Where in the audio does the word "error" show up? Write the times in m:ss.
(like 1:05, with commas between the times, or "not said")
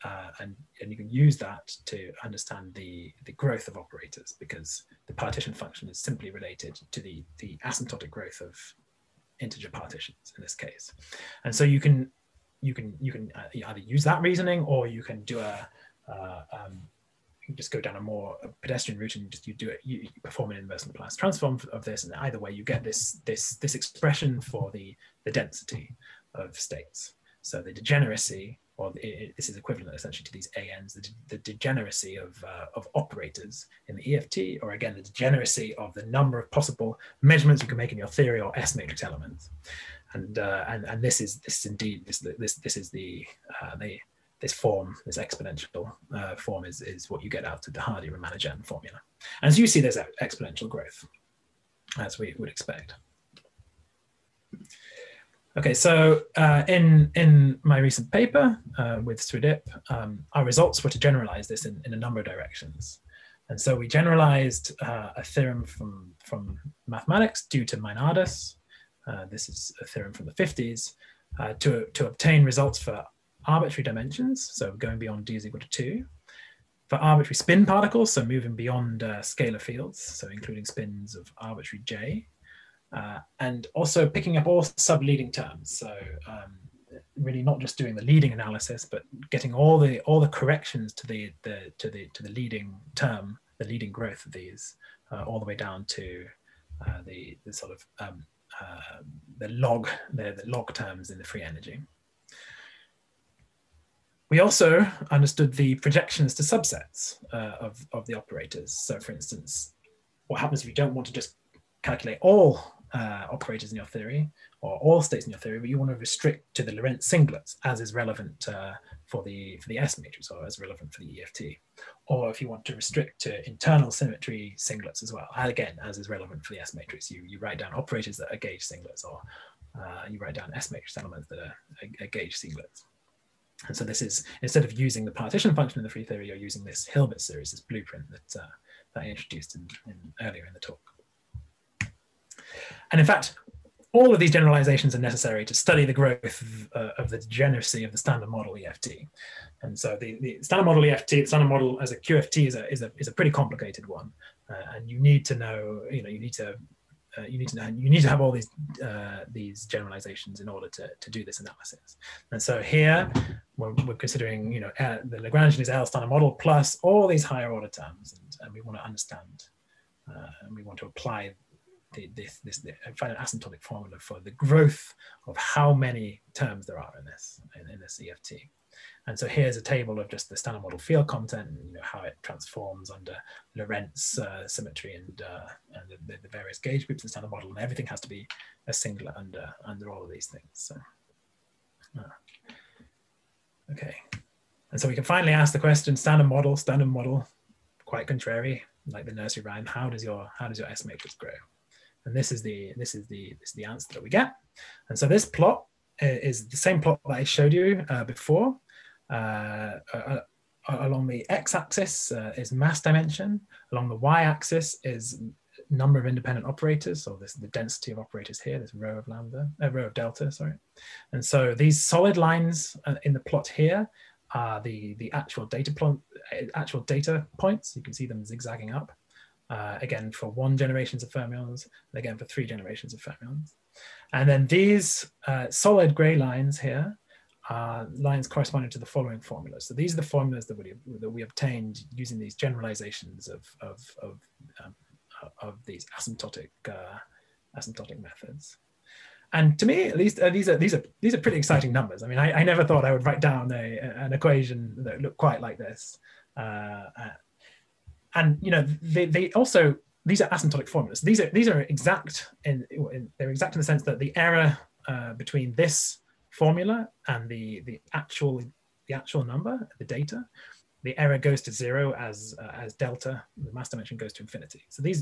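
4:24, 4:30.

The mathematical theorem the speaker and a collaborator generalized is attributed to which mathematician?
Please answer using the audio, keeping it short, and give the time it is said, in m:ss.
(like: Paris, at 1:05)
Meinardus, at 1:07.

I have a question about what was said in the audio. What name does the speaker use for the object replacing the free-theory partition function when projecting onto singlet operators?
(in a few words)
Hilbert series.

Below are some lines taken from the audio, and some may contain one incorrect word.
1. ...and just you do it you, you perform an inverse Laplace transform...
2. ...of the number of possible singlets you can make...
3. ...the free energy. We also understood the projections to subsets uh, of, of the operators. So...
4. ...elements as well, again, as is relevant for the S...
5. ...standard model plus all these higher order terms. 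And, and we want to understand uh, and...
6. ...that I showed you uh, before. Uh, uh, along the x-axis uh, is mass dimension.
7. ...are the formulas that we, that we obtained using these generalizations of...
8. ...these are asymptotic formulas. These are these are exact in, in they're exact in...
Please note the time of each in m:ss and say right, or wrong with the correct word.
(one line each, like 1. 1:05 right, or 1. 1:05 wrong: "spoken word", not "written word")
1. 0:19 right
2. 0:35 wrong: "measurements", not "singlets"
3. 1:41 right
4. 2:04 wrong: "singlets", not "elements"
5. 2:45 right
6. 3:27 right
7. 3:59 right
8. 4:20 right.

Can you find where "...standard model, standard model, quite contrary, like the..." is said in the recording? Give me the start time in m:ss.
3:15.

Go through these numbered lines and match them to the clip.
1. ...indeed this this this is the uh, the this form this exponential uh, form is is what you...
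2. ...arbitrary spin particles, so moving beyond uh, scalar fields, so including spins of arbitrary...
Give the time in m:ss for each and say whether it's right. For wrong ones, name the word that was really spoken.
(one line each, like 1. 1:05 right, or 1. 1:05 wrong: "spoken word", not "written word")
1. 0:41 right
2. 1:16 right.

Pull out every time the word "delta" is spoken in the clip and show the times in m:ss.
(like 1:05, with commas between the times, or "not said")
3:39, 4:32.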